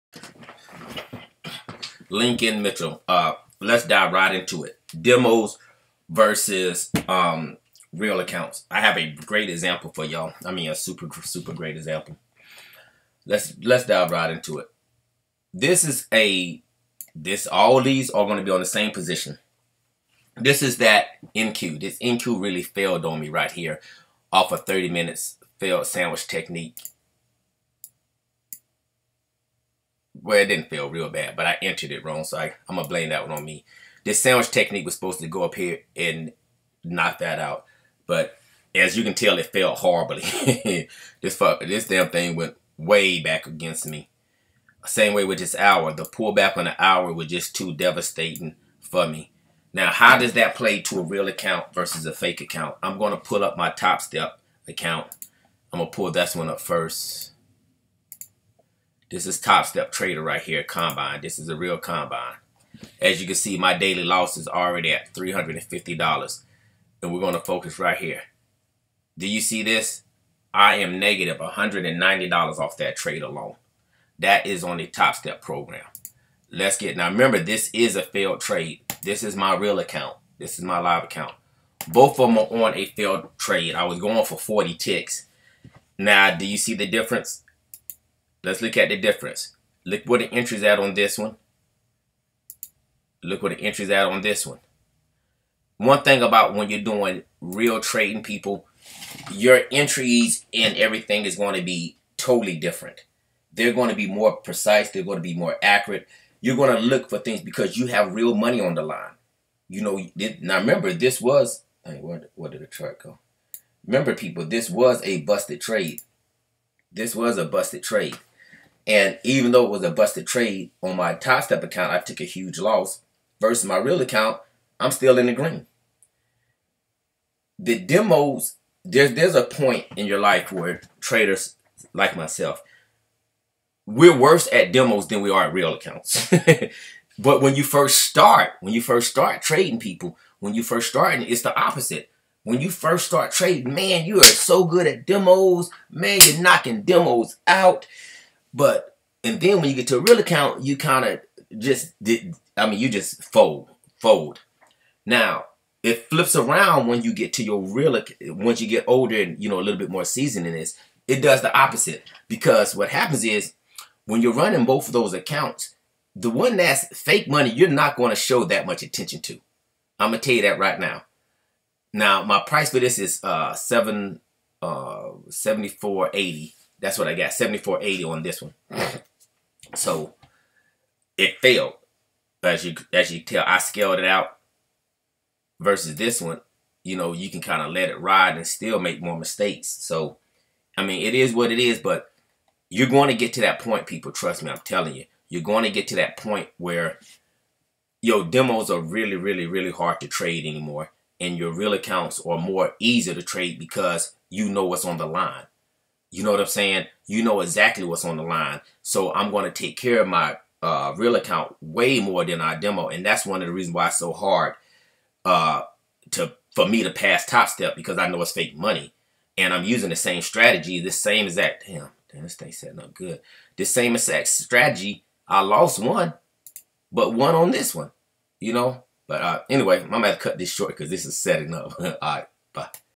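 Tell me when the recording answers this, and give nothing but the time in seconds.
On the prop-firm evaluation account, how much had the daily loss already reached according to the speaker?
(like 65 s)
65 s.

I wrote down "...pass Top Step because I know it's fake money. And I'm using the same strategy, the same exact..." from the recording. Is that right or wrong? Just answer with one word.
right.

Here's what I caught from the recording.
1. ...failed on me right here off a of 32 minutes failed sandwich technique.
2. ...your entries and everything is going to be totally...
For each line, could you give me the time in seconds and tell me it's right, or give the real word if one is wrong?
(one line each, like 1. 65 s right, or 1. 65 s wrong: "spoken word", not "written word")
1. 22 s wrong: "30", not "32"
2. 99 s right.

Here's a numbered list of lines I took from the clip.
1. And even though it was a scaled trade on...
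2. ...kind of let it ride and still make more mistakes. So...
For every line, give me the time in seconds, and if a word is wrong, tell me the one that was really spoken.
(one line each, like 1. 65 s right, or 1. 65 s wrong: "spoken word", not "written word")
1. 118 s wrong: "busted", not "scaled"
2. 187 s right.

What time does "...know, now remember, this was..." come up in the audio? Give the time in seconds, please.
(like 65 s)
109 s.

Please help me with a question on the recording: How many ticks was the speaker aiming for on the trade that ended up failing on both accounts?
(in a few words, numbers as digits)
40 ticks.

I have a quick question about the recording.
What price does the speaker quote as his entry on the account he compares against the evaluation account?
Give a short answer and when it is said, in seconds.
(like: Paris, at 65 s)
7480, at 177 s.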